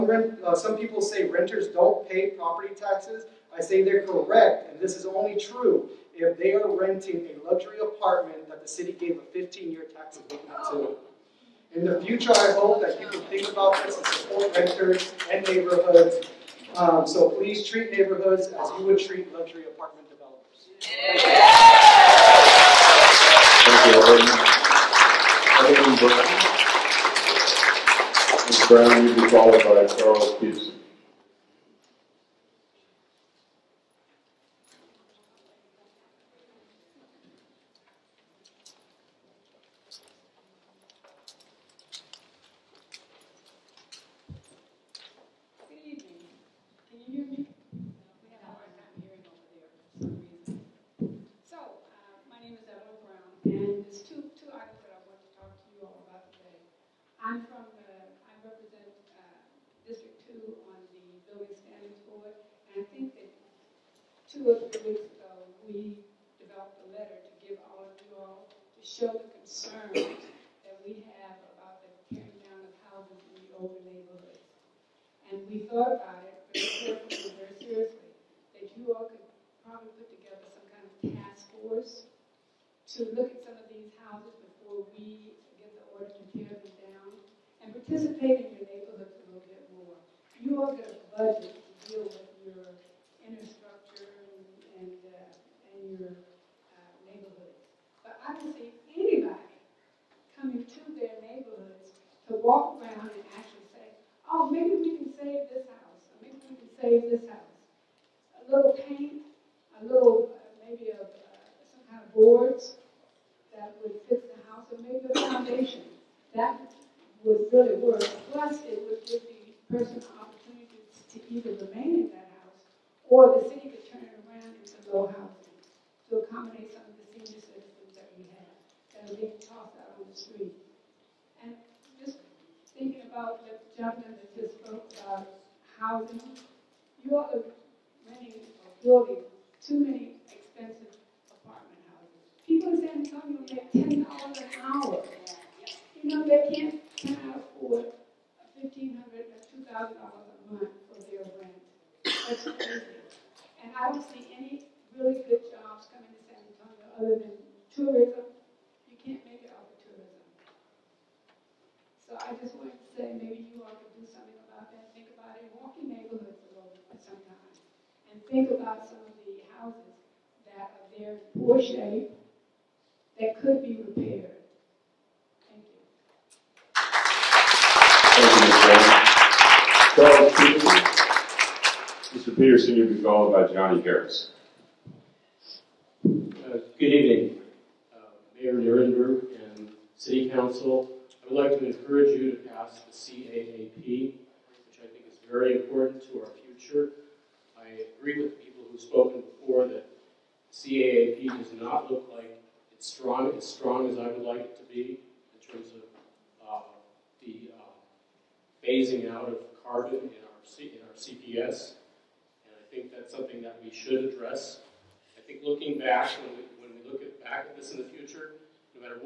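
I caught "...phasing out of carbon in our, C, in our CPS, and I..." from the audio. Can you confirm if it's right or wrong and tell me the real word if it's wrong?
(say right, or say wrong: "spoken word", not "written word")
right.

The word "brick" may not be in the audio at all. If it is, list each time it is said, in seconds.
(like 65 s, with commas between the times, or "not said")
not said.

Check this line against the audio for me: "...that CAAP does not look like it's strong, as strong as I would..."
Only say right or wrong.
right.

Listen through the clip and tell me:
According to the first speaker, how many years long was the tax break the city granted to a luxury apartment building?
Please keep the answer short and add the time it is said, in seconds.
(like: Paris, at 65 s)
15 years, at 9 s.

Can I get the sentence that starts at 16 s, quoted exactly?
Um, so please treat neighborhoods as you would treat luxury apartment developers.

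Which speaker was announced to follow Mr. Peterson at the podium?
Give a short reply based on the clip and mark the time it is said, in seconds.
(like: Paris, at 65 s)
Johnny Harris, at 183 s.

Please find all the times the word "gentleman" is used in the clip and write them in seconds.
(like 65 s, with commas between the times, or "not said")
133 s.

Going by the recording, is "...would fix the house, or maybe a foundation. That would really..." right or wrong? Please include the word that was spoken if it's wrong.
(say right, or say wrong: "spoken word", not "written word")
right.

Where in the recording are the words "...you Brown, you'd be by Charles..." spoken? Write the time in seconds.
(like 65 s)
26 s.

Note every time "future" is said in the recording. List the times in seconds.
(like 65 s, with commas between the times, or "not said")
12 s, 196 s, 217 s.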